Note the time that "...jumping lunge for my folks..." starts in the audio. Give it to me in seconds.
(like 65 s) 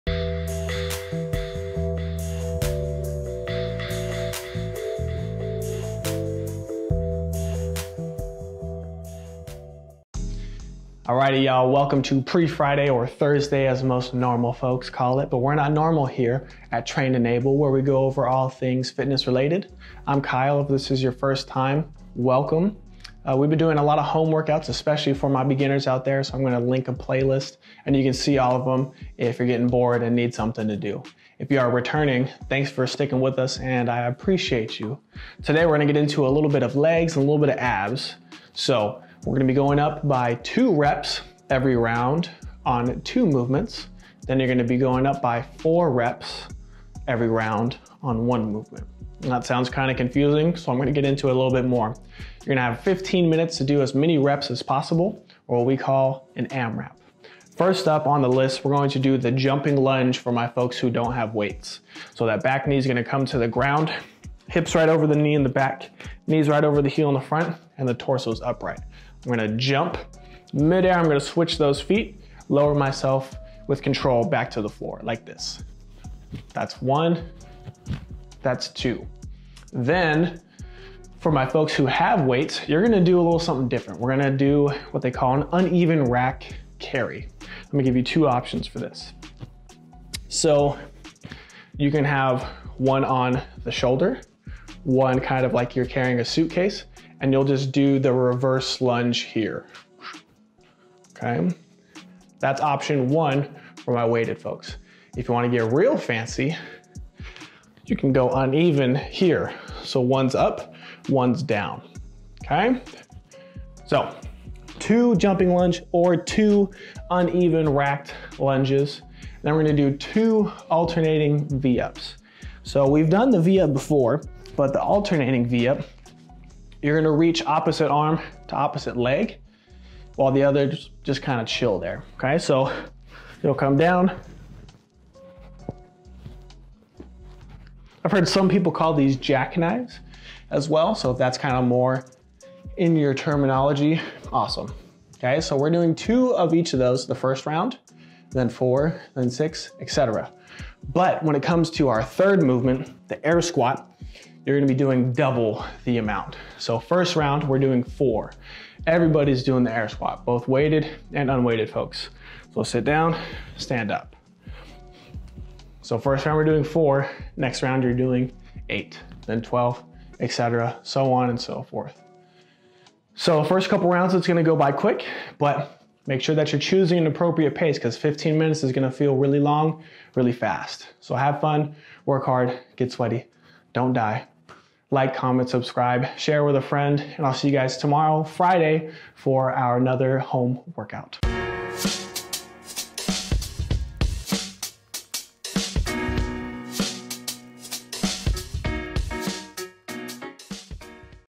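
59 s.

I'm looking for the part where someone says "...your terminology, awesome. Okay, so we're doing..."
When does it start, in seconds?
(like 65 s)
142 s.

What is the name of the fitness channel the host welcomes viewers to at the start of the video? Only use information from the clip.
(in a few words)
Train And Able.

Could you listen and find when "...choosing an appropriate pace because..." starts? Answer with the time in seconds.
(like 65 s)
176 s.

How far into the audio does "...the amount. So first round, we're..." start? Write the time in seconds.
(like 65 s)
155 s.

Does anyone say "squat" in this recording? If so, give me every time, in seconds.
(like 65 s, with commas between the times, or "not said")
153 s, 159 s.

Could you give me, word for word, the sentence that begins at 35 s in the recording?
Today, we're gonna get into a little bit of legs and a little bit of abs.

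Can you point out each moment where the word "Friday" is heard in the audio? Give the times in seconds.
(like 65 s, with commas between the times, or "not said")
12 s, 188 s.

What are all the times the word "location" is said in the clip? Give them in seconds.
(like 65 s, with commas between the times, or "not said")
not said.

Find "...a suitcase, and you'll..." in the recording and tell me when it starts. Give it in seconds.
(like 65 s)
96 s.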